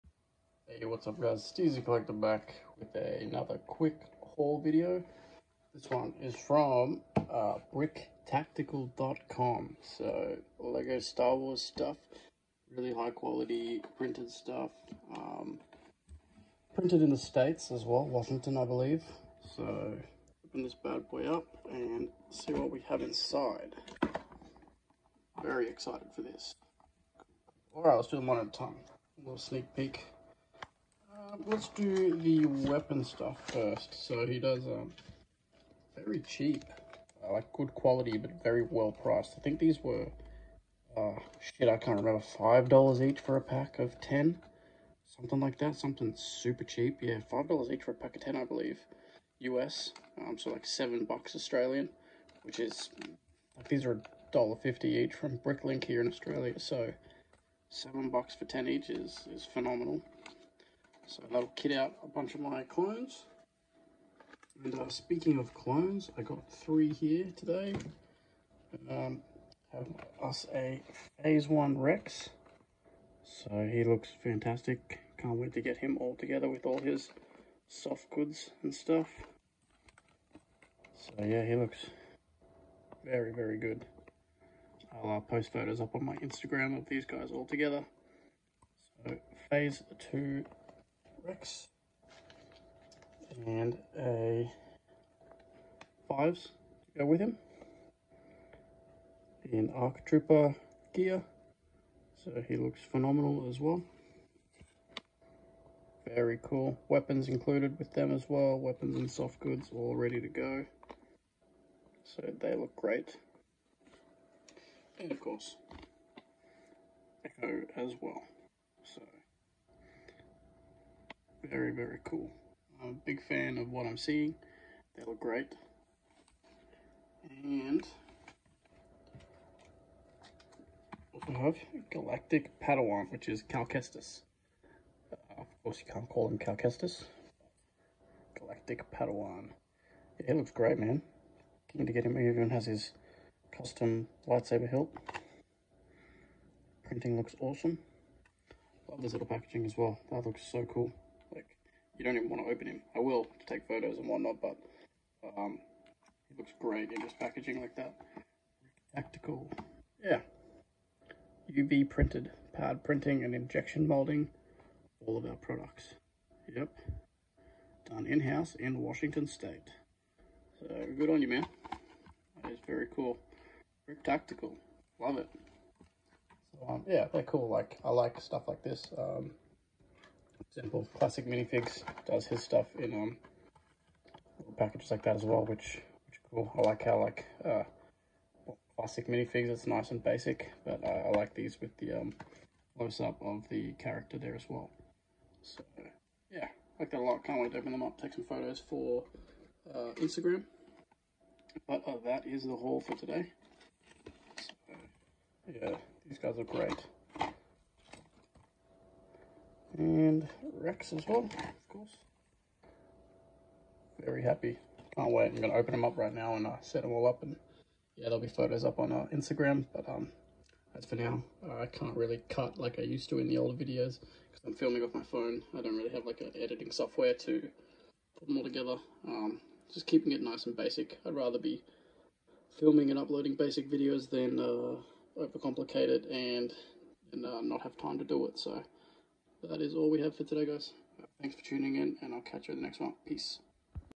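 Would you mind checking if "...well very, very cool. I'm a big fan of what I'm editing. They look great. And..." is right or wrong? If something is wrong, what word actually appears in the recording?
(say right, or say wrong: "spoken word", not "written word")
wrong: "seeing", not "editing".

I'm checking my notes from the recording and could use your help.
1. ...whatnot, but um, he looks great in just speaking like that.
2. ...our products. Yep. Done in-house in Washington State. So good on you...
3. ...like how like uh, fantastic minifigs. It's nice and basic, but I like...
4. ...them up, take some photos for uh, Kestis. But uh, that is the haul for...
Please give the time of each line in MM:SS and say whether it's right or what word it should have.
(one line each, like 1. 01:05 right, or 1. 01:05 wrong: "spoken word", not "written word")
1. 02:34 wrong: "packaging", not "speaking"
2. 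02:45 right
3. 03:06 wrong: "classic", not "fantastic"
4. 03:17 wrong: "Instagram", not "Kestis".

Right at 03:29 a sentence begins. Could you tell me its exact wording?
And Rex as well, of course.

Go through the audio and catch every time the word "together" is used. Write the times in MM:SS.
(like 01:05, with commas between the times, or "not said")
01:16, 01:27, 03:48.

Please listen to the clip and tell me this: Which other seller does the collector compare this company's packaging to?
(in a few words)
Simple classic minifigs.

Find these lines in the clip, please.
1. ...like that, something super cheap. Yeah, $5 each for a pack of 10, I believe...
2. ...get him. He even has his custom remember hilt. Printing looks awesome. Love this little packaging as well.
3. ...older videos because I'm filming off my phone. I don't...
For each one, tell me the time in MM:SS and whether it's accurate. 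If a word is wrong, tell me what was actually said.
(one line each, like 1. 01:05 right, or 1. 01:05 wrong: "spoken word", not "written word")
1. 00:45 right
2. 02:21 wrong: "lightsaber", not "remember"
3. 03:43 right.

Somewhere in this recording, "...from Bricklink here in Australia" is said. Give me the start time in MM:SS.
00:55.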